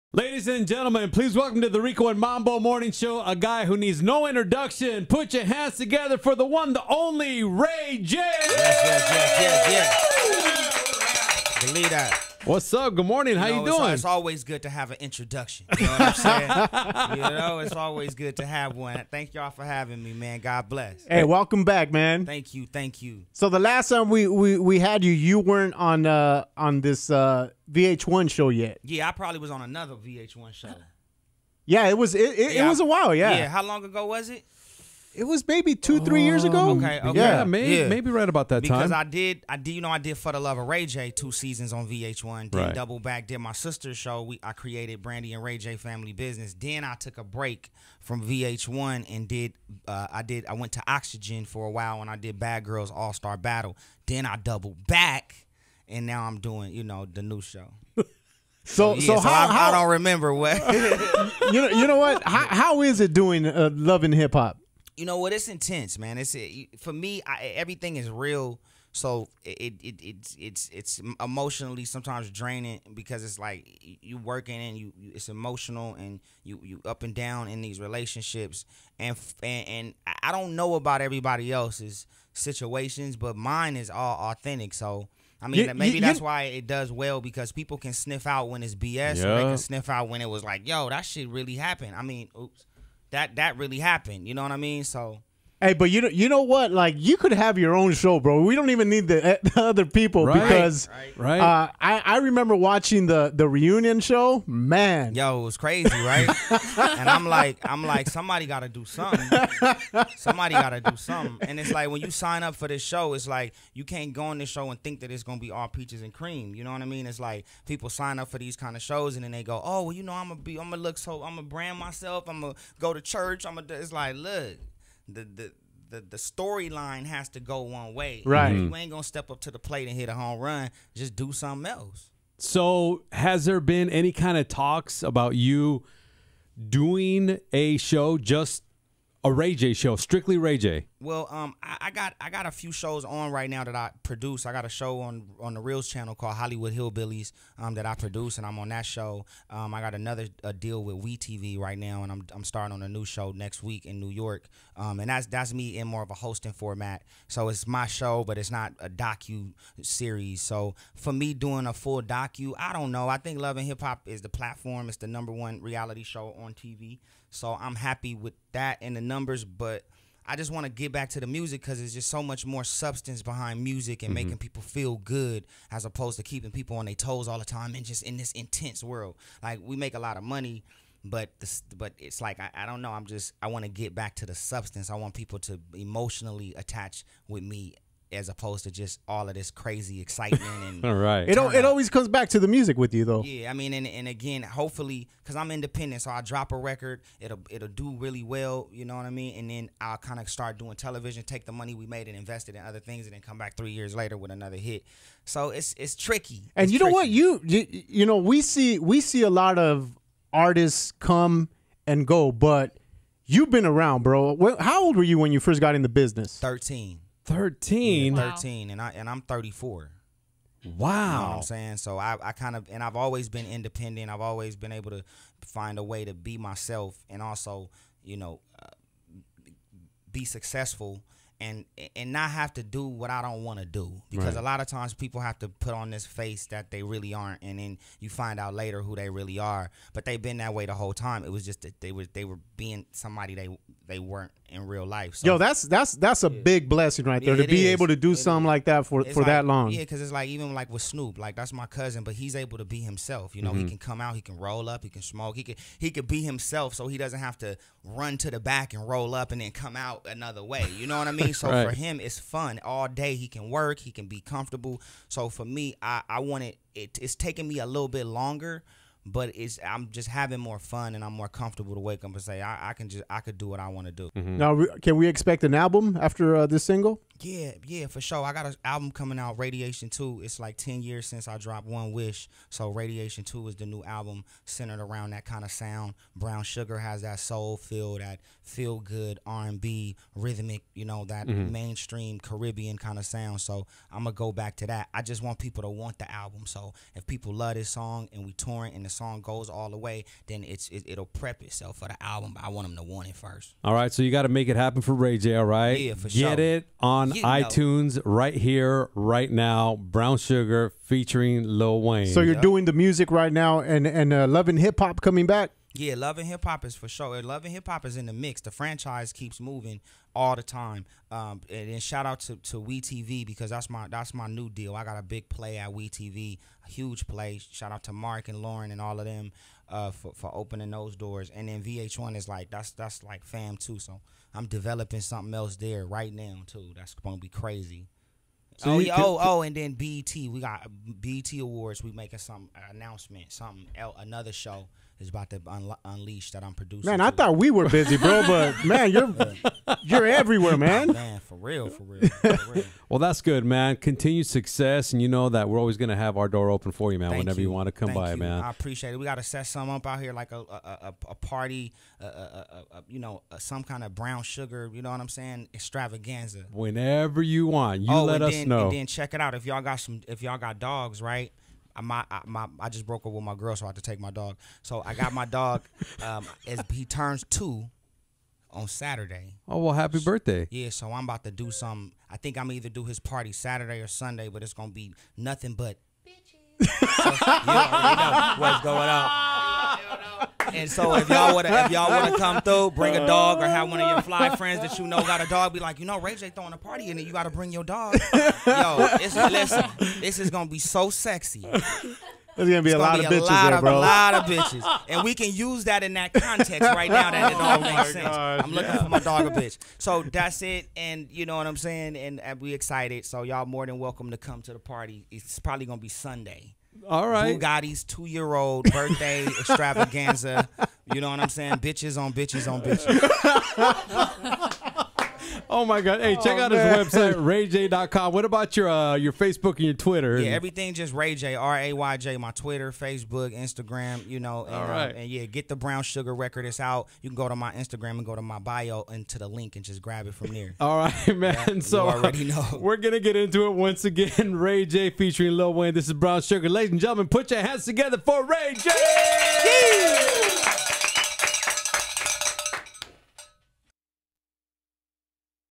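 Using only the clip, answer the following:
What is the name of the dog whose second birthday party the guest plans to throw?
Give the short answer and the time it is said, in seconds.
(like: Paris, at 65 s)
Bugatti, at 417 s.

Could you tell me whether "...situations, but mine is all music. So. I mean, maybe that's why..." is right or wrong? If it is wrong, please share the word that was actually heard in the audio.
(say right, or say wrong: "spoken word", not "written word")
wrong: "authentic", not "music".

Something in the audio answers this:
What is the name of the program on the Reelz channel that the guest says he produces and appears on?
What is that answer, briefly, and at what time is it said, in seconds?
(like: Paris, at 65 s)
Hollywood Hillbillies, at 146 s.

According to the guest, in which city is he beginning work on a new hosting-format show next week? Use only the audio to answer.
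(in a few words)
New York.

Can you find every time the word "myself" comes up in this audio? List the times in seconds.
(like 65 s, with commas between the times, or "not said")
121 s, 226 s.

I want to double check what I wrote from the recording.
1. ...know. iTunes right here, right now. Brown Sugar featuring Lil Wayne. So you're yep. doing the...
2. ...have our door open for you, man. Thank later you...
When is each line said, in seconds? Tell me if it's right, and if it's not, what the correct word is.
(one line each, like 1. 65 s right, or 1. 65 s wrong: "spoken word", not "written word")
1. 307 s right
2. 355 s wrong: "whenever", not "later".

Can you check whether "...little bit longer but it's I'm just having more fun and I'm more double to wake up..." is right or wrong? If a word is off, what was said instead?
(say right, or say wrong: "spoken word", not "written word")
wrong: "comfortable", not "double".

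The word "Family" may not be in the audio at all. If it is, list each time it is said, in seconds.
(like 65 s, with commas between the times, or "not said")
45 s.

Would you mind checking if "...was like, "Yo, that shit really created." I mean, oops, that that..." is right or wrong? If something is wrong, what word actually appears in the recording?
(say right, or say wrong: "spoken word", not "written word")
wrong: "happened", not "created".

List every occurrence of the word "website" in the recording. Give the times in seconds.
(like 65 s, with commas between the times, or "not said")
426 s.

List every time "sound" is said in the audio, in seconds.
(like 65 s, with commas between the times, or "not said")
285 s, 293 s.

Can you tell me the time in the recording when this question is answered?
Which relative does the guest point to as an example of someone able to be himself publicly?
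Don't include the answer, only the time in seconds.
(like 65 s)
250 s.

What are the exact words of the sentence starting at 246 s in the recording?
big blessing right there yeah, to be is.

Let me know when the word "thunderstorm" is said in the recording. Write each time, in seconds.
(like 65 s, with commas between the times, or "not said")
not said.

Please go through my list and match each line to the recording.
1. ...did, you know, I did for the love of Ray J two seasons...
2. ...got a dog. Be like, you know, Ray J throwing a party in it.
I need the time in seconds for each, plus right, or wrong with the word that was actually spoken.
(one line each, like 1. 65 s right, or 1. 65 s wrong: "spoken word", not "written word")
1. 39 s right
2. 395 s right.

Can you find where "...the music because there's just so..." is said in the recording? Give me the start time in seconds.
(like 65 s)
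171 s.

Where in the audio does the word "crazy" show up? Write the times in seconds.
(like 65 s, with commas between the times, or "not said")
105 s, 189 s, 337 s.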